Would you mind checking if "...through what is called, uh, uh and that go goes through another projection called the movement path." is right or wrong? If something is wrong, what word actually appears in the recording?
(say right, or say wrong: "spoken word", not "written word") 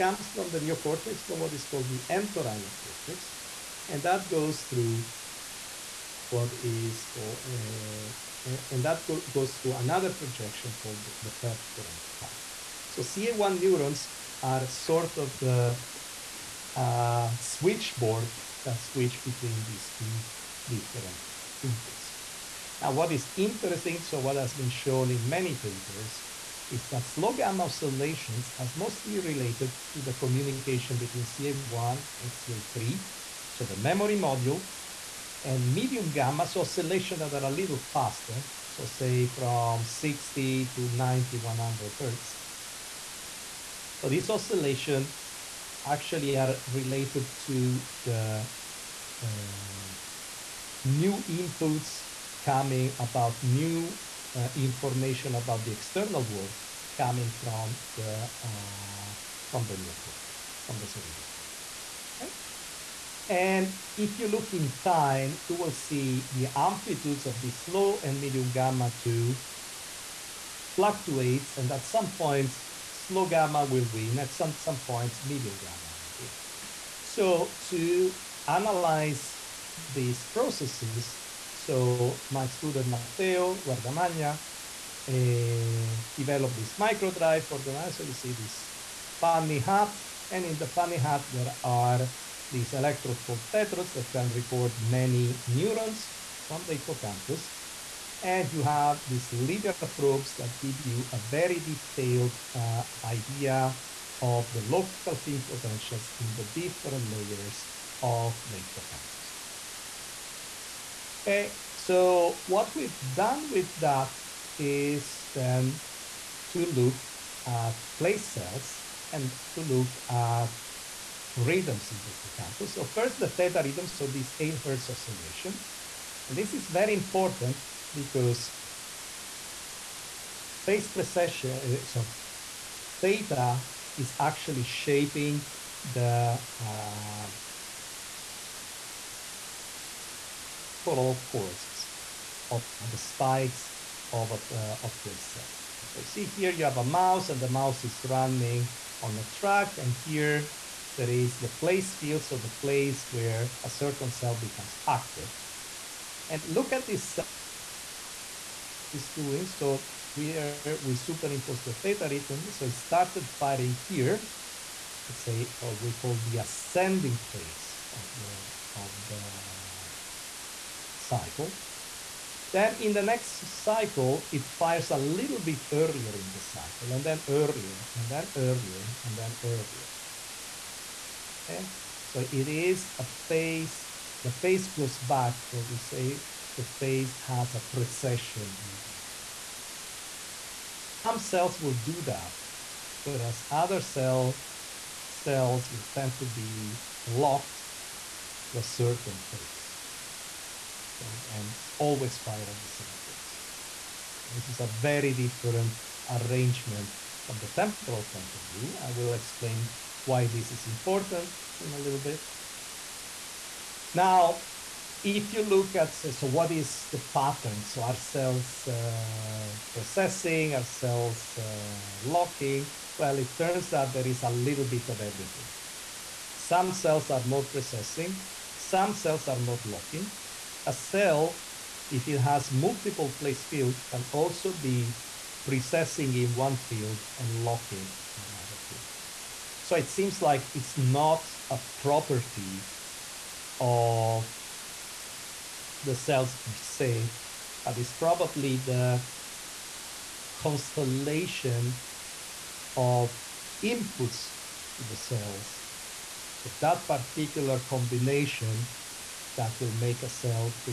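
wrong: "perforant", not "movement".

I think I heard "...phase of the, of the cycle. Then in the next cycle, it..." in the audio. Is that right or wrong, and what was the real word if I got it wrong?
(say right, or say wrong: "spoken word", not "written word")
right.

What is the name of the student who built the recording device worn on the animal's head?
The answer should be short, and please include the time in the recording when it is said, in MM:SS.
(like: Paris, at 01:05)
Matteo Guardamagna, at 01:22.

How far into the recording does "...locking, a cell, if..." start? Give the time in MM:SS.
03:49.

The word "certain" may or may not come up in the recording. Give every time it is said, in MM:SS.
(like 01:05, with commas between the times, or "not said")
02:33, 03:18.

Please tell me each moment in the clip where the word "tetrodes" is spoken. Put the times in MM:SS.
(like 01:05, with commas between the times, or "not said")
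01:33.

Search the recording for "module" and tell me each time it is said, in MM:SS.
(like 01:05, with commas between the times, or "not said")
00:34.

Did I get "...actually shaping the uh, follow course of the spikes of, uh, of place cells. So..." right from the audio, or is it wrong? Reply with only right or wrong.
right.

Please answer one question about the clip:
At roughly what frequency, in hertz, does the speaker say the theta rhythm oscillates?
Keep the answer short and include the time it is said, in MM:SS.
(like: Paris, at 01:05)
8 hertz, at 02:04.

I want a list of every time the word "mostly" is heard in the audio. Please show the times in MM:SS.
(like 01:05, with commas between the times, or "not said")
00:28.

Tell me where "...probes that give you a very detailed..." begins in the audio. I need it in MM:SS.
01:39.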